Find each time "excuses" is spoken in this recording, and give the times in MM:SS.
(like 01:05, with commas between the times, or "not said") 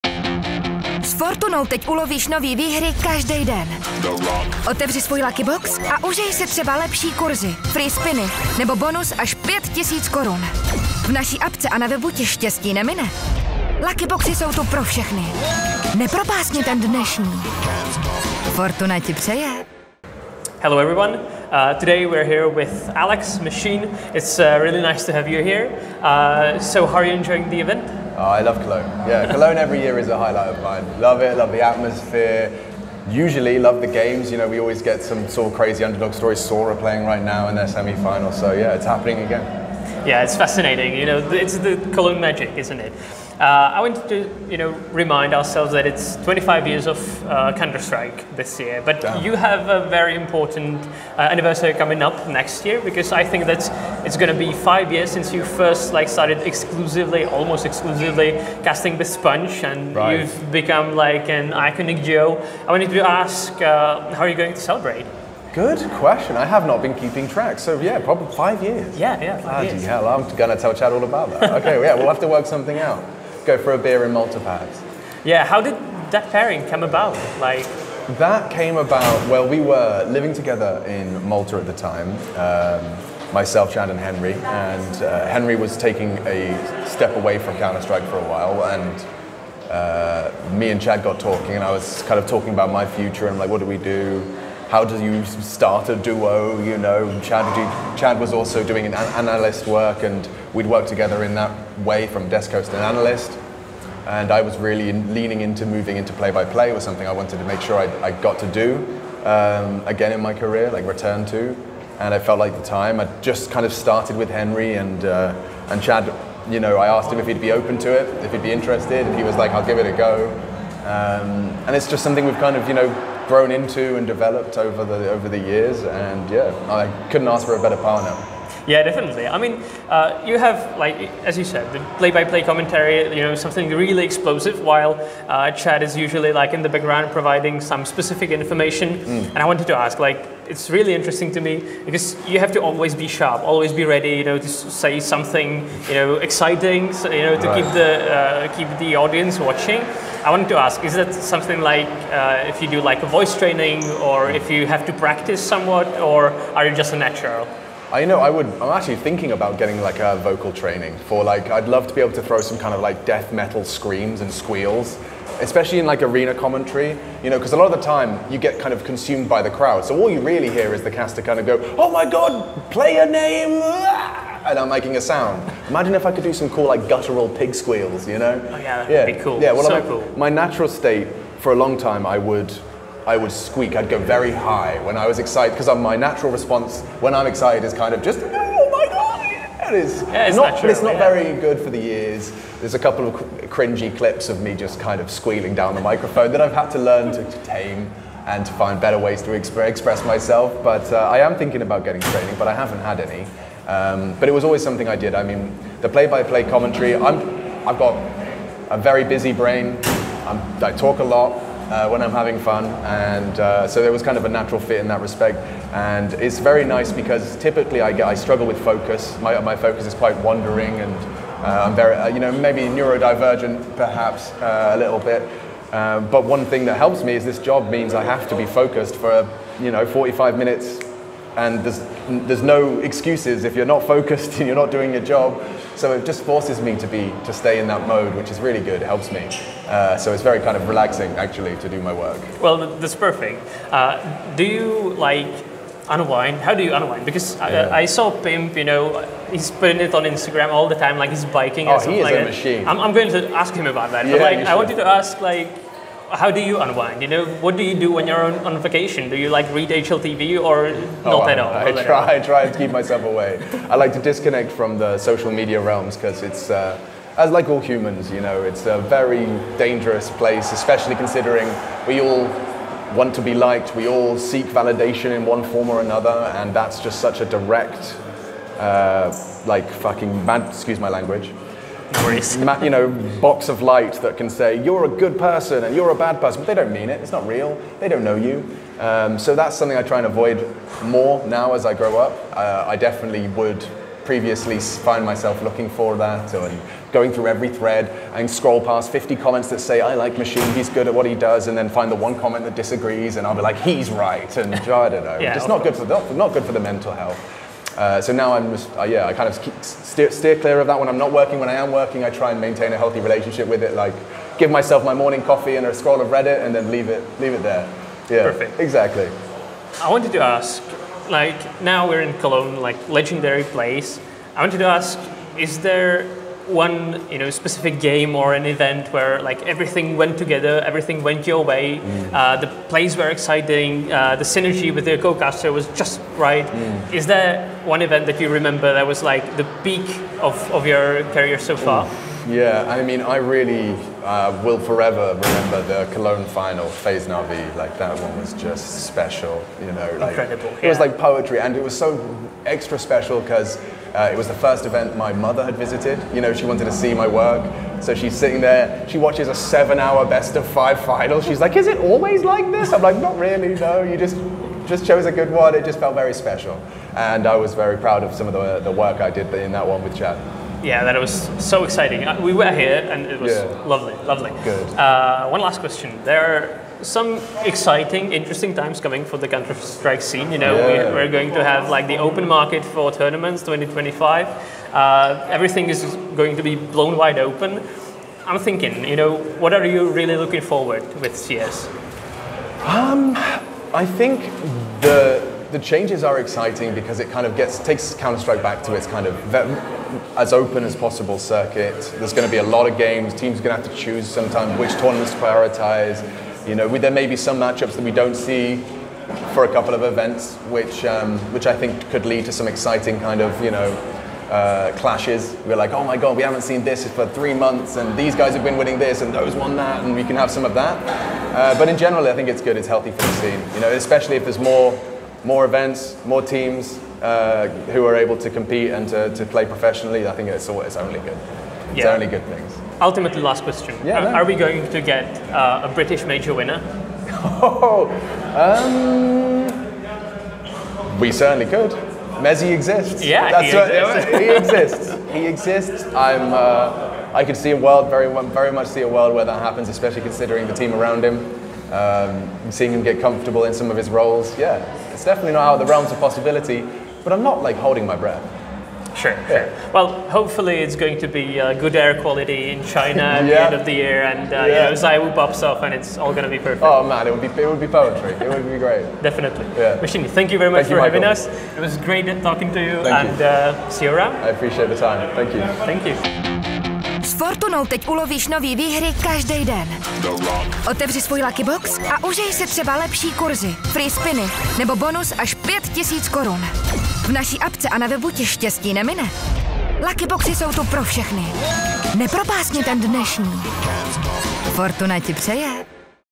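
03:52, 04:40.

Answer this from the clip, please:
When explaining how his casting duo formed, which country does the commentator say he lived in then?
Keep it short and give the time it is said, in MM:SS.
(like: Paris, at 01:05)
Malta, at 01:21.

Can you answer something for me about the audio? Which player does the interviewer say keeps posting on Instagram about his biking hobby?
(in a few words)
Pimp.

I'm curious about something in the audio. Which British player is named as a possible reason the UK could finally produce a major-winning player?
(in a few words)
mezii.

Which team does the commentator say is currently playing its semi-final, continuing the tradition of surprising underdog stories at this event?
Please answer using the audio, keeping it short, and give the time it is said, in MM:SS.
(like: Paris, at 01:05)
Sora, at 00:36.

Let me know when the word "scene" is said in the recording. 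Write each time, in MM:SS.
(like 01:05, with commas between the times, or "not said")
06:20, 07:03.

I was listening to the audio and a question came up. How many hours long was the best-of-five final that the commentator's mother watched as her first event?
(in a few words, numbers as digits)
7.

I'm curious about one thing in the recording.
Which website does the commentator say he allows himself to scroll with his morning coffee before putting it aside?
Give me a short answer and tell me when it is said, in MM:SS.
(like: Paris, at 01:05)
Reddit, at 05:16.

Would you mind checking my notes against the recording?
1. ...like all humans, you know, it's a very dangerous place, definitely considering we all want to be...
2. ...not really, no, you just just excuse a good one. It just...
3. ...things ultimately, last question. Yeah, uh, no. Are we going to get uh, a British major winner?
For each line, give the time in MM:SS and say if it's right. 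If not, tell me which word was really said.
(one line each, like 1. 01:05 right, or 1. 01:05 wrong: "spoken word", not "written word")
1. 04:27 wrong: "especially", not "definitely"
2. 06:02 wrong: "chose", not "excuse"
3. 07:12 right.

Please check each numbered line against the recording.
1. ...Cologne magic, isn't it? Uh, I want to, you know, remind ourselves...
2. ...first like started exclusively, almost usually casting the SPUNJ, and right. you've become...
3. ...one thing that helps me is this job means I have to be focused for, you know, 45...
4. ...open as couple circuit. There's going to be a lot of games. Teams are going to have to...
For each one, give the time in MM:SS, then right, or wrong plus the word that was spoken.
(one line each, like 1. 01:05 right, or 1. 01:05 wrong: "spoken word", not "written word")
1. 00:41 right
2. 00:55 wrong: "exclusively", not "usually"
3. 03:46 right
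4. 06:40 wrong: "possible", not "couple".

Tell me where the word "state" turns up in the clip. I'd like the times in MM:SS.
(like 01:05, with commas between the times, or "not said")
03:00.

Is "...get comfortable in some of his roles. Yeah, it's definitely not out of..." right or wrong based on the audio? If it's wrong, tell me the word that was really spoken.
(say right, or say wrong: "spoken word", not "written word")
right.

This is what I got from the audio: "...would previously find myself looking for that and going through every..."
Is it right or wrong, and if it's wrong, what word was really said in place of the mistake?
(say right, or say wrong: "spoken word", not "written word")
right.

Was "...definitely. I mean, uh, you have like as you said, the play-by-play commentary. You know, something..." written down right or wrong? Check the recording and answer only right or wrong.
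right.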